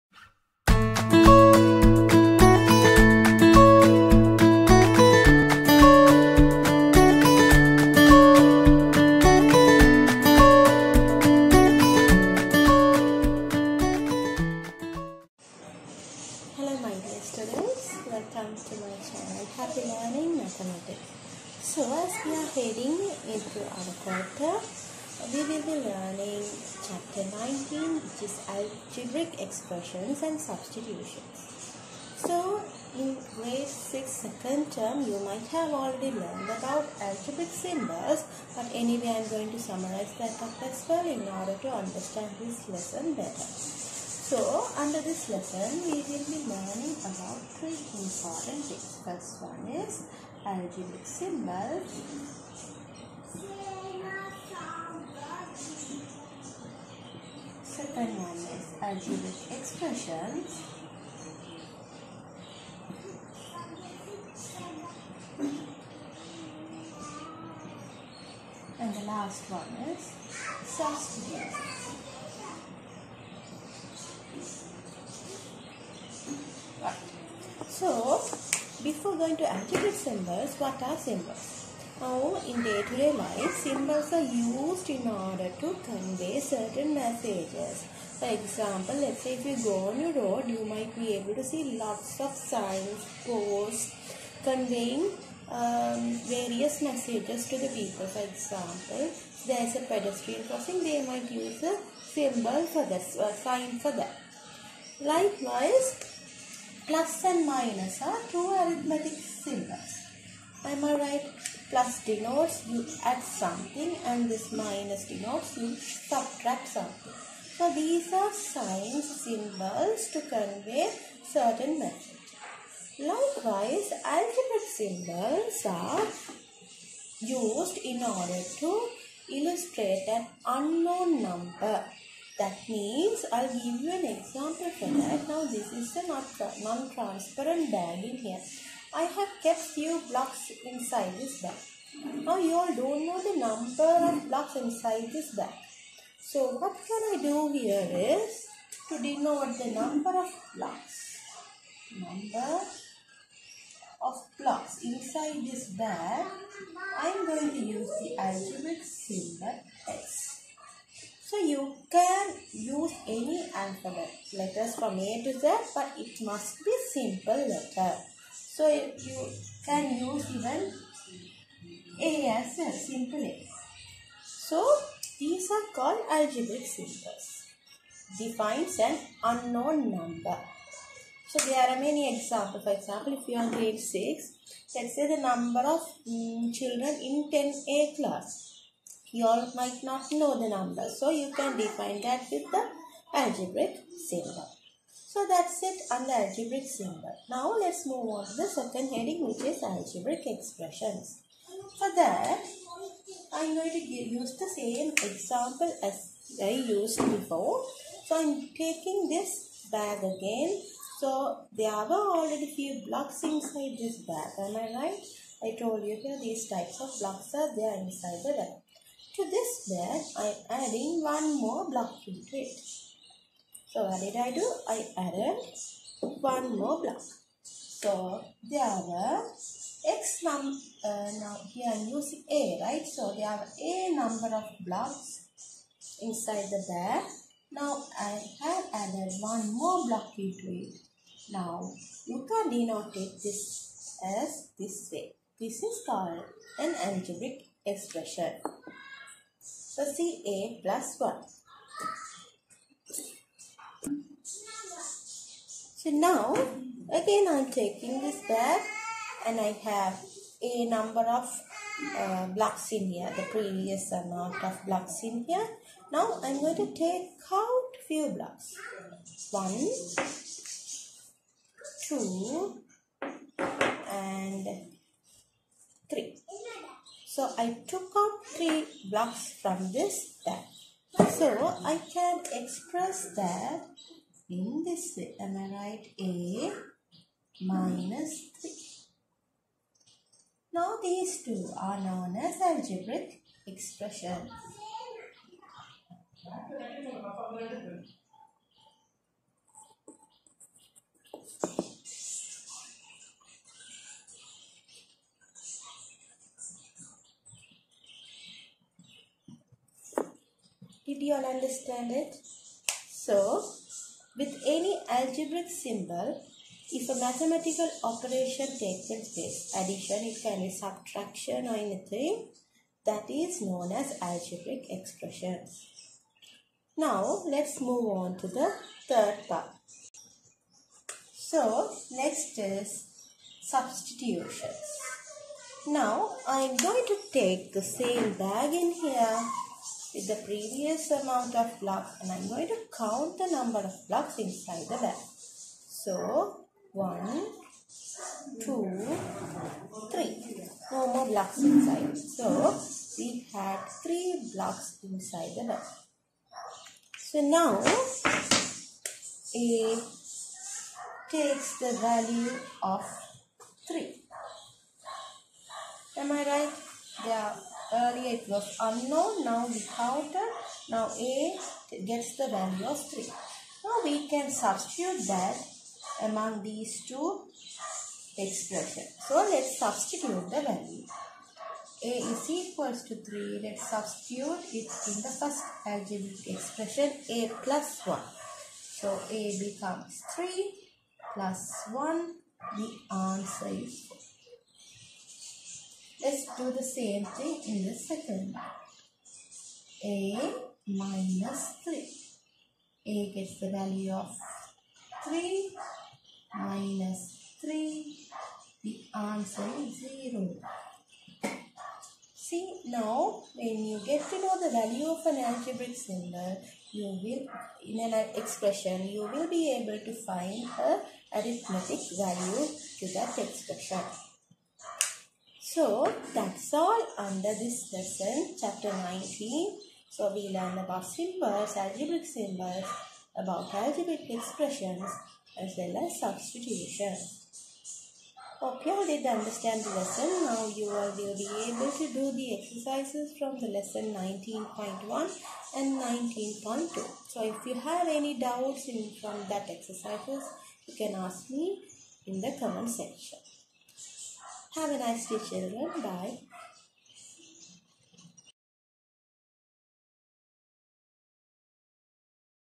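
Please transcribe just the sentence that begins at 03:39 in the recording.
To this bag, I'm adding one more block into it.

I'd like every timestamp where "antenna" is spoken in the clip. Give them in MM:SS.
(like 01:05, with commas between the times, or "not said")
not said.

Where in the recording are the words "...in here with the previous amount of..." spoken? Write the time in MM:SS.
05:38.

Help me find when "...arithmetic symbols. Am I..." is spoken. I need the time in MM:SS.
01:48.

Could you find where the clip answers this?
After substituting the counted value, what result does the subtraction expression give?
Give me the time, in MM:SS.
06:48.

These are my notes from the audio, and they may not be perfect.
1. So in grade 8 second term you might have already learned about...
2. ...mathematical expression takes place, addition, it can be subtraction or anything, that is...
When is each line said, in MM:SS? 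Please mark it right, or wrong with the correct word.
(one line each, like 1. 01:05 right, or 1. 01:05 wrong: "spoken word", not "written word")
1. 00:32 wrong: "6", not "8"
2. 05:16 wrong: "operation", not "expression".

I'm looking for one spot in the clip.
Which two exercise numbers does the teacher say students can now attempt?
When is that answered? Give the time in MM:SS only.
07:23.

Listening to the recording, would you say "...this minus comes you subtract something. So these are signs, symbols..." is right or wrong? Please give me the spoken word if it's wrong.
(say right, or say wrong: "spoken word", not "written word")
wrong: "denotes", not "comes".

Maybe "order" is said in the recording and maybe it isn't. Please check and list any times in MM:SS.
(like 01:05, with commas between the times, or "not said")
00:41, 01:25, 02:08.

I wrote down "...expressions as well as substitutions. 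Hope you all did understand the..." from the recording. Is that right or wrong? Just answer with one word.
right.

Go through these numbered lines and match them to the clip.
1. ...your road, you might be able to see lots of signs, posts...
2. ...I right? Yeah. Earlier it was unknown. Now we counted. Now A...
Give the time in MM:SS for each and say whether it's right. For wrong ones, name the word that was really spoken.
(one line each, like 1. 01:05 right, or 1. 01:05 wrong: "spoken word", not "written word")
1. 01:30 right
2. 06:06 right.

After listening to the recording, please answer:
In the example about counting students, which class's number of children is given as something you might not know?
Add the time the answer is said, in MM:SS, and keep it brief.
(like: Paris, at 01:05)
10A, at 03:07.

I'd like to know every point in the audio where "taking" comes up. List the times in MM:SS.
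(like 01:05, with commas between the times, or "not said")
03:28, 04:17.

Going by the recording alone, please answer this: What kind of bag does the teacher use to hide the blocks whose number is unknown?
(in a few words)
non-transparent bag.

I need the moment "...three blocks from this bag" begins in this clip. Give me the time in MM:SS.
04:38.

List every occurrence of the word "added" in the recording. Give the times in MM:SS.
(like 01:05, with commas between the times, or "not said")
03:44, 03:58.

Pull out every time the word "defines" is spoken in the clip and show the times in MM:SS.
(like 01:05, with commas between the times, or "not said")
02:58, 03:11.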